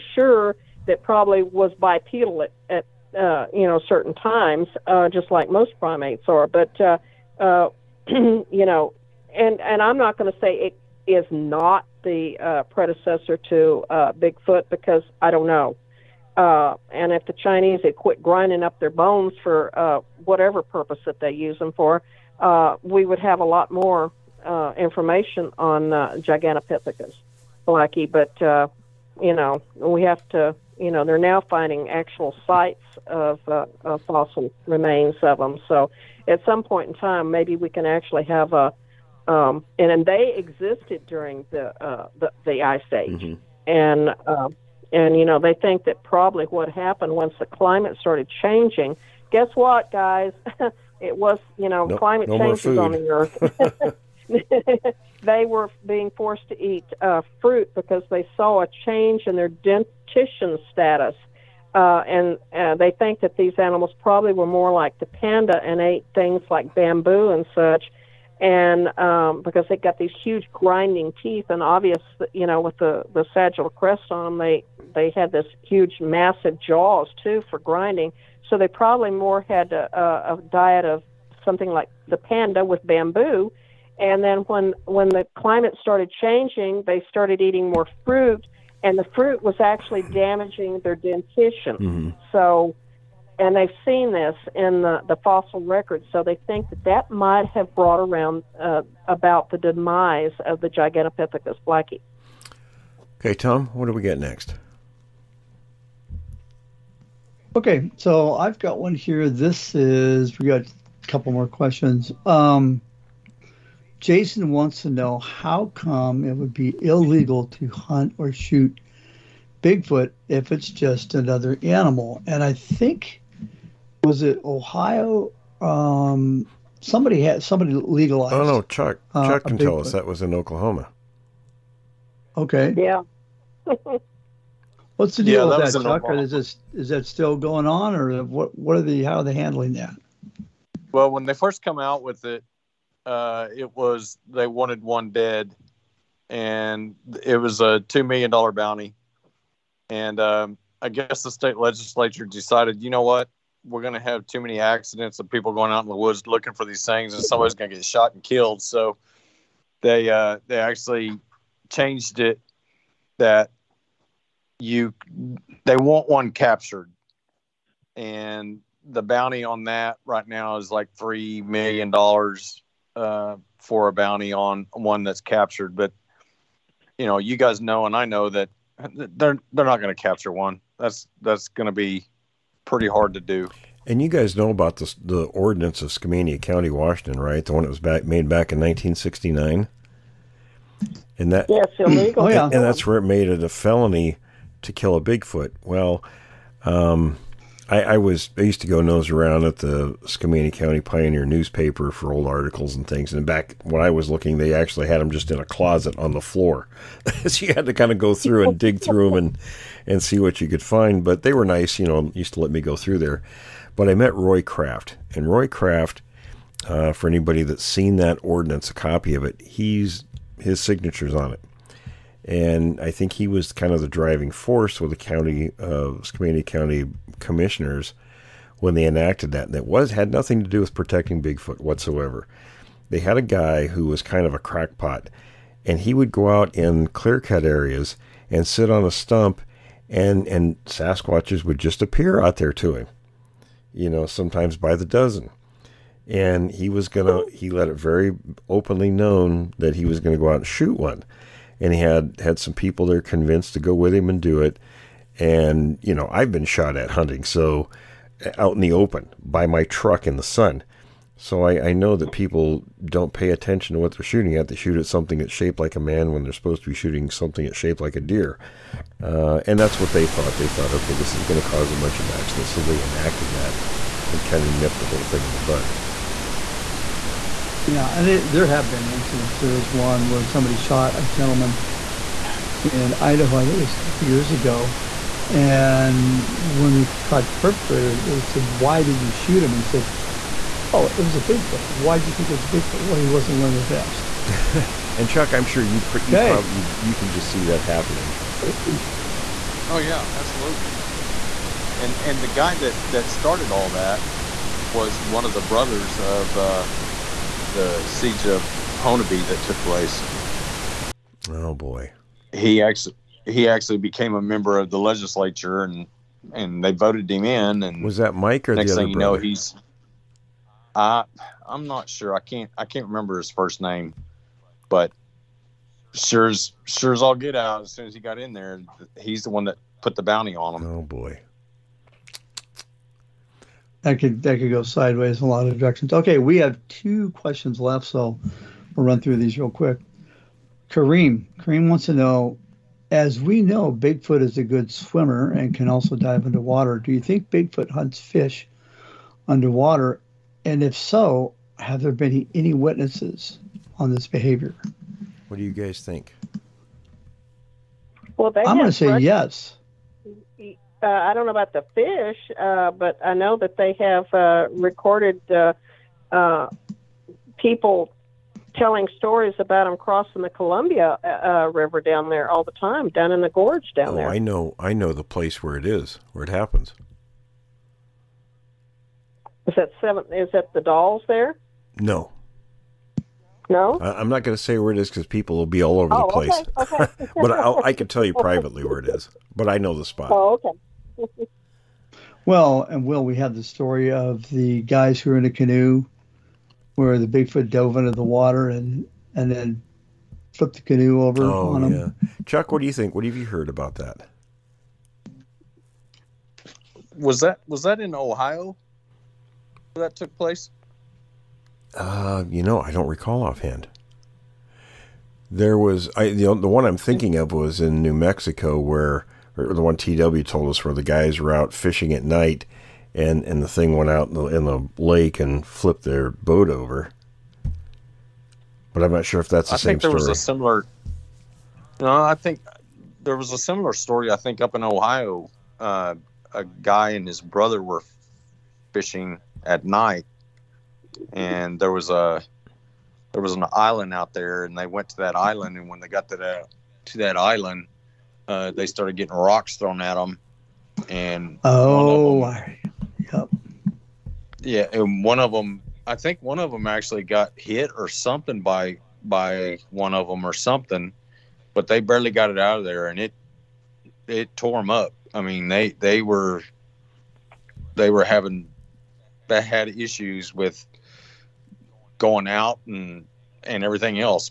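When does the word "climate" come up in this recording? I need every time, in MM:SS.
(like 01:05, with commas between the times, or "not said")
00:47, 00:51, 01:25.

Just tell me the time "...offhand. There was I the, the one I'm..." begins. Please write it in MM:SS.
06:53.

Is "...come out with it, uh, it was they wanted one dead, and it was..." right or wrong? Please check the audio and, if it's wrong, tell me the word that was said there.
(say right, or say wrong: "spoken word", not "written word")
right.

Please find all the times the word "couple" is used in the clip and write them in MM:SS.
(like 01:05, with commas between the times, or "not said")
01:51, 04:43.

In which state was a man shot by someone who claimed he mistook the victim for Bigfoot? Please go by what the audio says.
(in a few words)
Idaho.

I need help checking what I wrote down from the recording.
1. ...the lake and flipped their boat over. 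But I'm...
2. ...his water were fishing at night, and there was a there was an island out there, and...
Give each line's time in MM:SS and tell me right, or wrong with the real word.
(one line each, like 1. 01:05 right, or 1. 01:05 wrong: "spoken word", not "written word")
1. 07:04 right
2. 07:17 wrong: "brother", not "water".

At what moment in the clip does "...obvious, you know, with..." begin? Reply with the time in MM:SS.
01:11.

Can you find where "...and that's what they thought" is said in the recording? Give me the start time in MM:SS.
04:29.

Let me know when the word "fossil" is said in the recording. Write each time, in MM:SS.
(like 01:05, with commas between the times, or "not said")
00:34, 01:35.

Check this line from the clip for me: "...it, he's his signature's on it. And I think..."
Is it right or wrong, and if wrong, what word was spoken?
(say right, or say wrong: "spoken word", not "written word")
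right.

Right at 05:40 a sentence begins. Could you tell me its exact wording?
Karim, Karim wants to know, as we know, Bigfoot is a good swimmer and can also dive into water.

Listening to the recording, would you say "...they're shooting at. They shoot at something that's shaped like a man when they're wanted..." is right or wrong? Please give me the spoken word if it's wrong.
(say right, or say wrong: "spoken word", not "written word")
wrong: "supposed", not "wanted".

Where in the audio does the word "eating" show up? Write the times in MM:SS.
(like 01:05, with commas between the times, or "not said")
01:27.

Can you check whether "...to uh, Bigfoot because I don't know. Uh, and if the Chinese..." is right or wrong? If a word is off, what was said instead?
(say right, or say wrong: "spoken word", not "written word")
right.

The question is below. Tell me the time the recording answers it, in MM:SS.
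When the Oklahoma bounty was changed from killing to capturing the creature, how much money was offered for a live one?
02:50.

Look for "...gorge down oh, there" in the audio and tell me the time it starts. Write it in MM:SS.
06:13.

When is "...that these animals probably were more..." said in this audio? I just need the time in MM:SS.
01:03.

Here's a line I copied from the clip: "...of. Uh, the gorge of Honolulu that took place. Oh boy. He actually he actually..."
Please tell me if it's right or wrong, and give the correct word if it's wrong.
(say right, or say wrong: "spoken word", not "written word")
wrong: "siege", not "gorge".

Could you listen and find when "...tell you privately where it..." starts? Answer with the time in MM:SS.
06:27.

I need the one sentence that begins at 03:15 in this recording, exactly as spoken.
Well, um, I, I, was I used to go nose around at the Skamania County Pioneer newspaper for old articles and things.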